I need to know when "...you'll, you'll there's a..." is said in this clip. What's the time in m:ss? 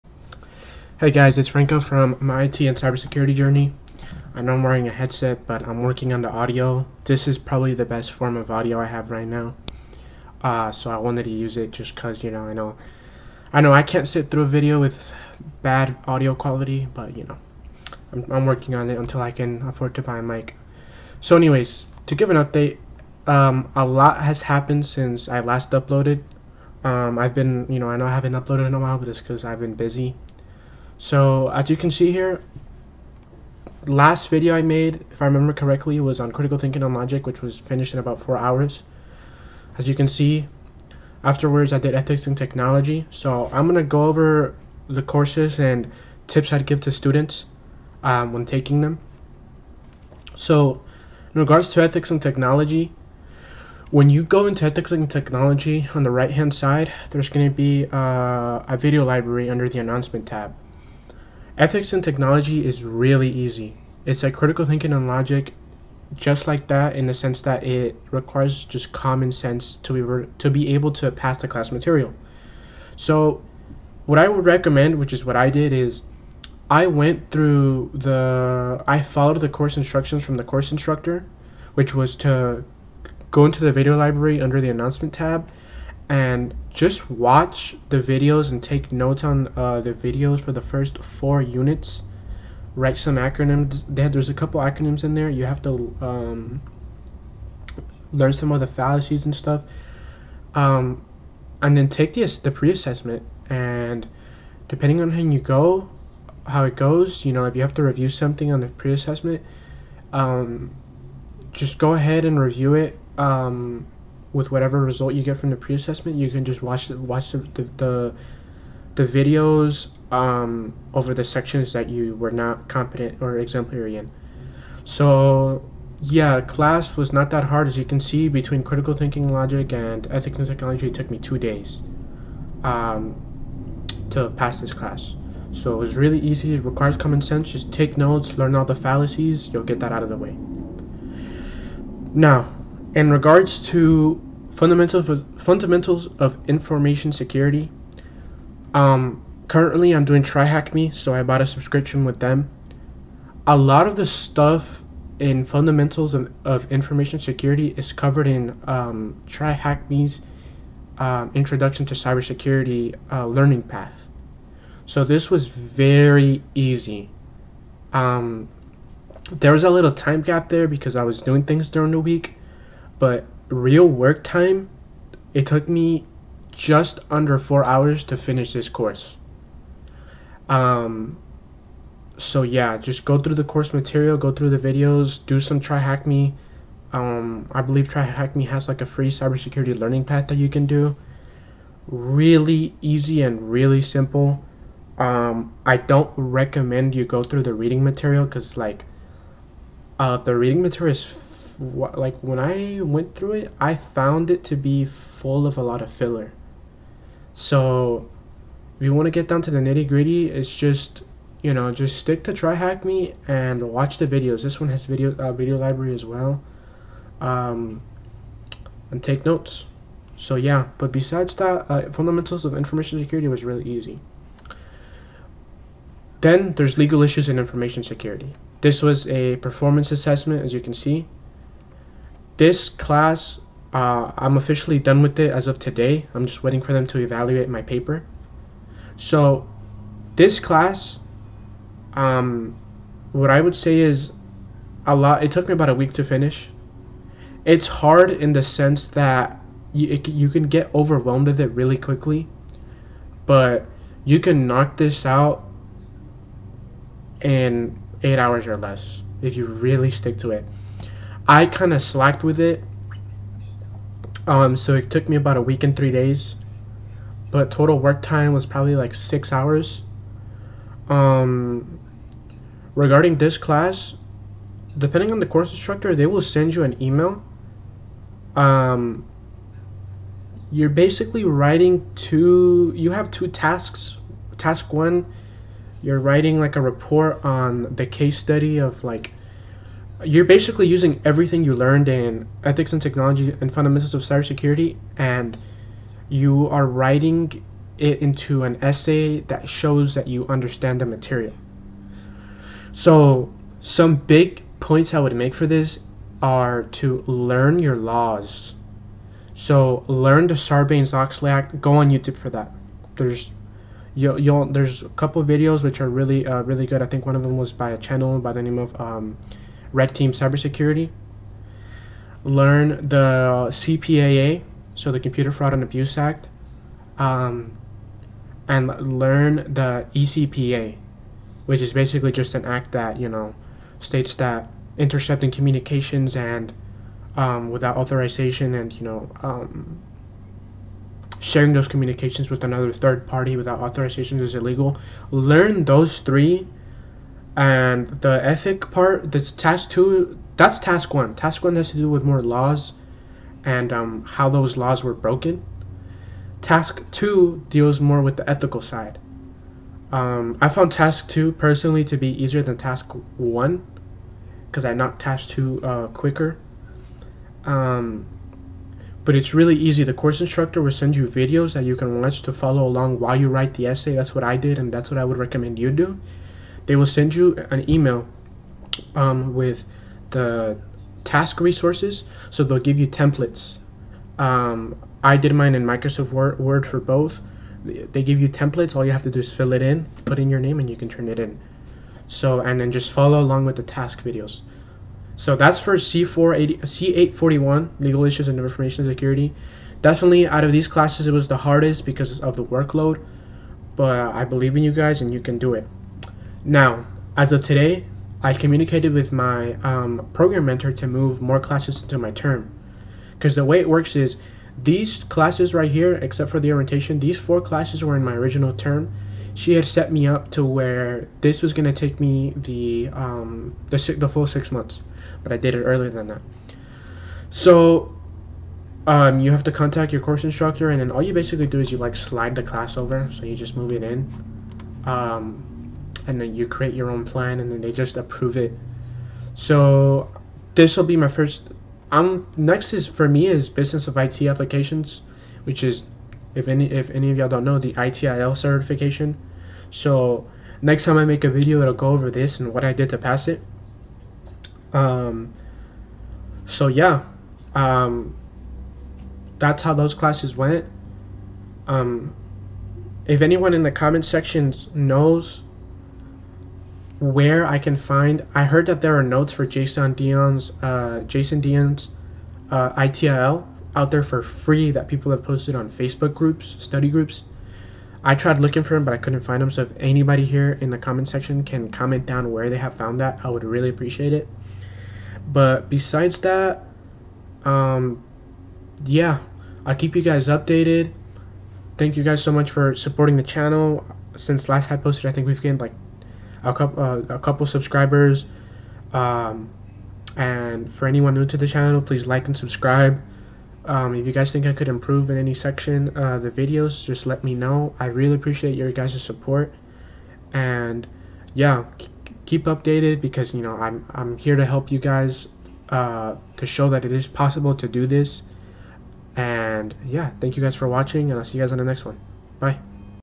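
5:13.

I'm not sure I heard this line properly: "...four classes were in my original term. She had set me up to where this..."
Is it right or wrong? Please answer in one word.
right.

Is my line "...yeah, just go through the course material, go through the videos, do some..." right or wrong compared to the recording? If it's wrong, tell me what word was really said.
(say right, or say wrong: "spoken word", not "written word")
right.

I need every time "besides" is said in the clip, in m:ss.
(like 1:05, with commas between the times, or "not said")
3:40, 8:05.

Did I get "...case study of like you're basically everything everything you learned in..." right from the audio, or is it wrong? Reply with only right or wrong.
wrong.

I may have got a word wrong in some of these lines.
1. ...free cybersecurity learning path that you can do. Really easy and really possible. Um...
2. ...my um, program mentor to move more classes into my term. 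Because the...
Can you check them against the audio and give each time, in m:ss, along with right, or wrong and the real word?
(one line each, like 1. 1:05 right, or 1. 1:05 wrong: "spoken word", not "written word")
1. 3:08 wrong: "simple", not "possible"
2. 6:49 right.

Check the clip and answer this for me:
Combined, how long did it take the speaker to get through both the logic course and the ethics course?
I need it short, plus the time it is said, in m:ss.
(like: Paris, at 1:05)
2 days, at 2:11.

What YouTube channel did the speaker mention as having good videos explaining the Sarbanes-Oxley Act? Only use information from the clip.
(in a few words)
Red Team Cybersecurity.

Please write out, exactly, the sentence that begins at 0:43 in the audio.
So I'm gonna go over the courses and tips I'd give to students um, when taking them.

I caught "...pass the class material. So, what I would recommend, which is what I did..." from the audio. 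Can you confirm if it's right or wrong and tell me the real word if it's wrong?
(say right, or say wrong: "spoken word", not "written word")
right.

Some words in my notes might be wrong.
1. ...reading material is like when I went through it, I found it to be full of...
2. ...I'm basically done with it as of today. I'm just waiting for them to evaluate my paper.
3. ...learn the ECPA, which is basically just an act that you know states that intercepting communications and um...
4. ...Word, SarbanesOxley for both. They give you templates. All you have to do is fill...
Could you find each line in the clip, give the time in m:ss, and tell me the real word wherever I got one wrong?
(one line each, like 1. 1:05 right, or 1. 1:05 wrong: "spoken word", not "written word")
1. 3:20 right
2. 3:54 wrong: "officially", not "basically"
3. 5:28 right
4. 6:26 wrong: "Word", not "SarbanesOxley".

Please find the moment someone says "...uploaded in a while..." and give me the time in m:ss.
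0:28.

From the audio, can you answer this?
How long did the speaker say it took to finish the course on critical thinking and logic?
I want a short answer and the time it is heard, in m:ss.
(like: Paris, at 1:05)
about 4 hours, at 0:37.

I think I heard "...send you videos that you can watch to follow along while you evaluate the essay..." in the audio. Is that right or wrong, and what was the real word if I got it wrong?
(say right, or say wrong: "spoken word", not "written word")
wrong: "write", not "evaluate".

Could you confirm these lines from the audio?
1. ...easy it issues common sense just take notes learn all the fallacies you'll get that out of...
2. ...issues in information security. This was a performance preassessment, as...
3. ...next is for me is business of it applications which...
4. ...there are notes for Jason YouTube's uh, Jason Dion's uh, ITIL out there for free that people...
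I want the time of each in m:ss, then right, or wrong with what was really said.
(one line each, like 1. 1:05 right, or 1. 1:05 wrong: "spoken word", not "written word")
1. 2:16 wrong: "requires", not "issues"
2. 3:47 wrong: "assessment", not "preassessment"
3. 7:22 right
4. 7:48 wrong: "Dion", not "YouTube".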